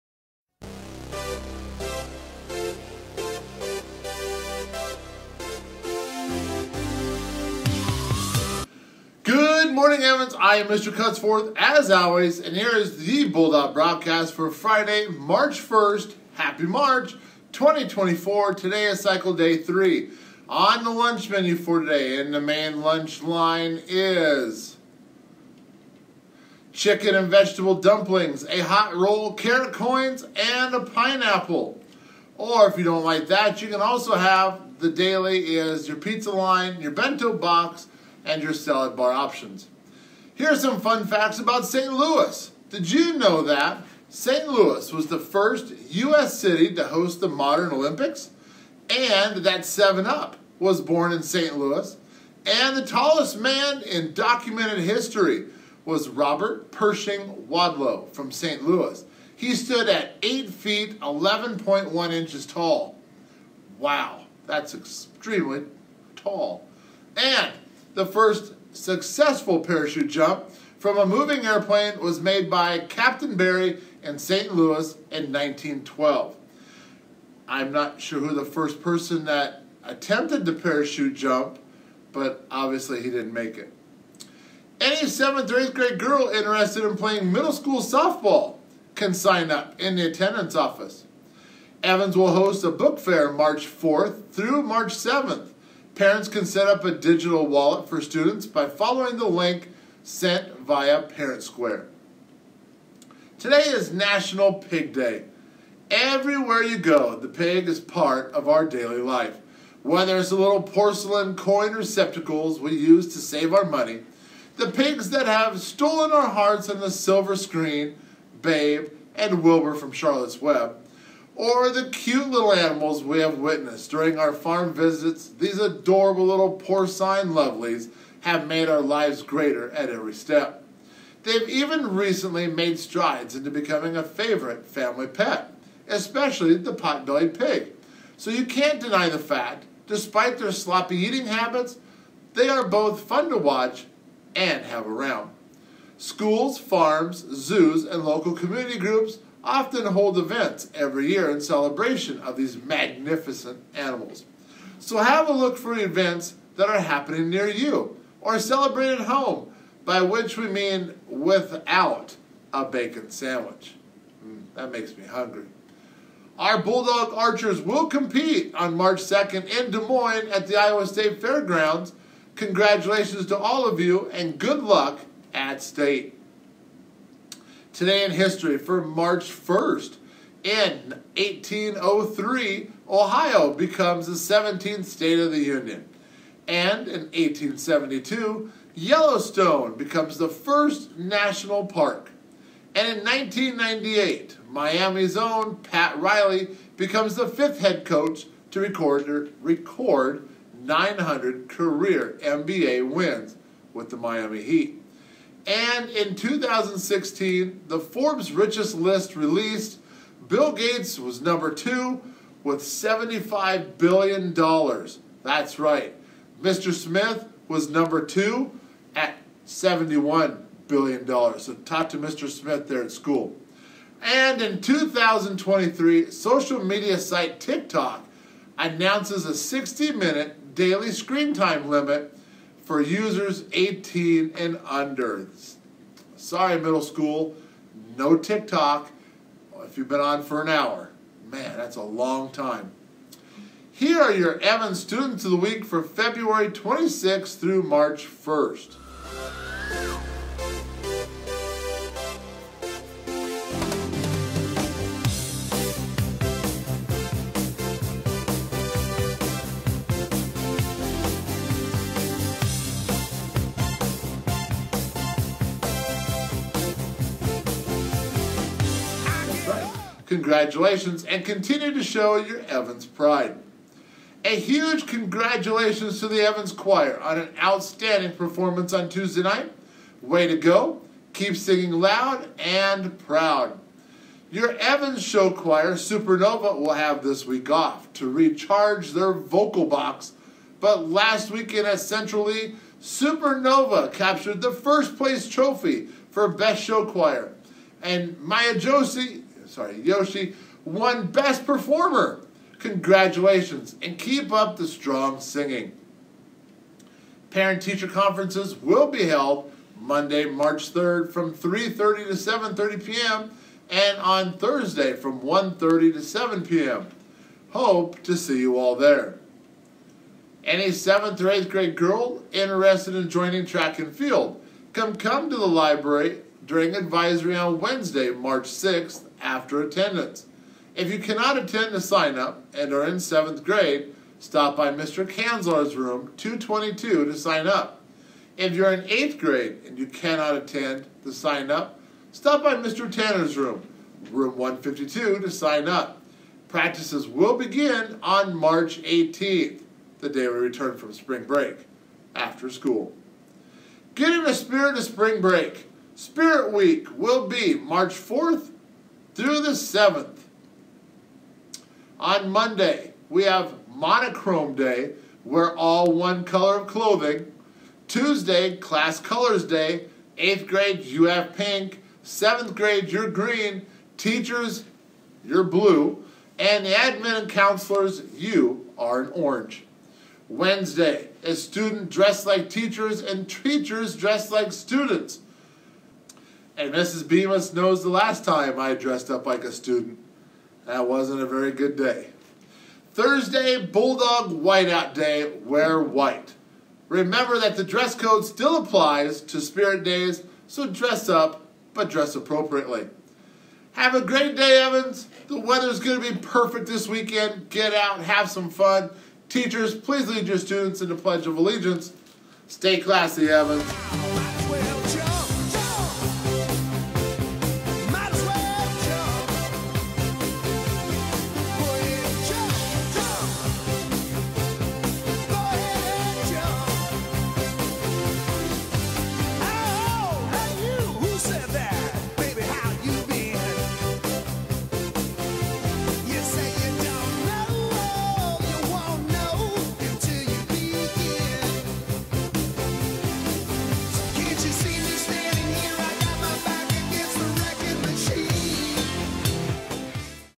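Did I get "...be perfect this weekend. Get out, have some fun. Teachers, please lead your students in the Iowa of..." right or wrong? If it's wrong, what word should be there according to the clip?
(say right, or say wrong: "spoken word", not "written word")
wrong: "Pledge", not "Iowa".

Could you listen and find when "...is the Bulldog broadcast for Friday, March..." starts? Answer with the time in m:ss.
0:12.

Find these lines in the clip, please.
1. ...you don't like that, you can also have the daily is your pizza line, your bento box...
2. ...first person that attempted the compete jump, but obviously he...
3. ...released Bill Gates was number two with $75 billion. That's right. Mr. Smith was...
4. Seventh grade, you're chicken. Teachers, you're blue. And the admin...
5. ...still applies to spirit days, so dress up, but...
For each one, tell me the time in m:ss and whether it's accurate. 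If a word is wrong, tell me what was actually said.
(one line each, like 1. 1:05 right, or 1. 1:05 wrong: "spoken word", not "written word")
1. 0:32 right
2. 1:18 wrong: "parachute", not "compete"
3. 3:29 right
4. 6:12 wrong: "green", not "chicken"
5. 6:38 right.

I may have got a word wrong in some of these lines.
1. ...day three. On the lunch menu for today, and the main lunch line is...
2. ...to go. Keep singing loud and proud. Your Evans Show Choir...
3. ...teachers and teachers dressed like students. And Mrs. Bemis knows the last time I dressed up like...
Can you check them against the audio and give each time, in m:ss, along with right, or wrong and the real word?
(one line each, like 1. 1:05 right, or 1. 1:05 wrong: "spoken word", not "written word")
1. 0:19 right
2. 4:40 right
3. 6:22 right.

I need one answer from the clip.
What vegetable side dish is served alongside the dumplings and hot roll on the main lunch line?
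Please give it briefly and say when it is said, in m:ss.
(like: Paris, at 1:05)
Carrot coins, at 0:29.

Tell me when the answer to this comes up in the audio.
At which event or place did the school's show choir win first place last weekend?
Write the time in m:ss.
4:51.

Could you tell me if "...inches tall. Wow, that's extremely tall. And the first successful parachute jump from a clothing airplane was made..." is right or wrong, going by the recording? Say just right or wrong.
wrong.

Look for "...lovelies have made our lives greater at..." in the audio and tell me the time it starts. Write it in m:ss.
2:07.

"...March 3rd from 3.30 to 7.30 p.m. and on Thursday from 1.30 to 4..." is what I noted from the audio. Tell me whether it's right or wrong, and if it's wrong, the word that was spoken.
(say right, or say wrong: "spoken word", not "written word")
wrong: "7", not "4".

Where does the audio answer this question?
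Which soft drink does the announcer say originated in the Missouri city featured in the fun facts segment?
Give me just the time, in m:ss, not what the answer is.
0:49.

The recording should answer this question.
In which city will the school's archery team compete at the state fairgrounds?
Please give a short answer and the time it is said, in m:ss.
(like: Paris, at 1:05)
Des Moines, at 2:49.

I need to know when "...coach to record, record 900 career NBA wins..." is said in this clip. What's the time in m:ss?
3:17.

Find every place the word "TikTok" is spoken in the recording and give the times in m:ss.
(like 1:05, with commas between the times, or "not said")
3:47, 3:58.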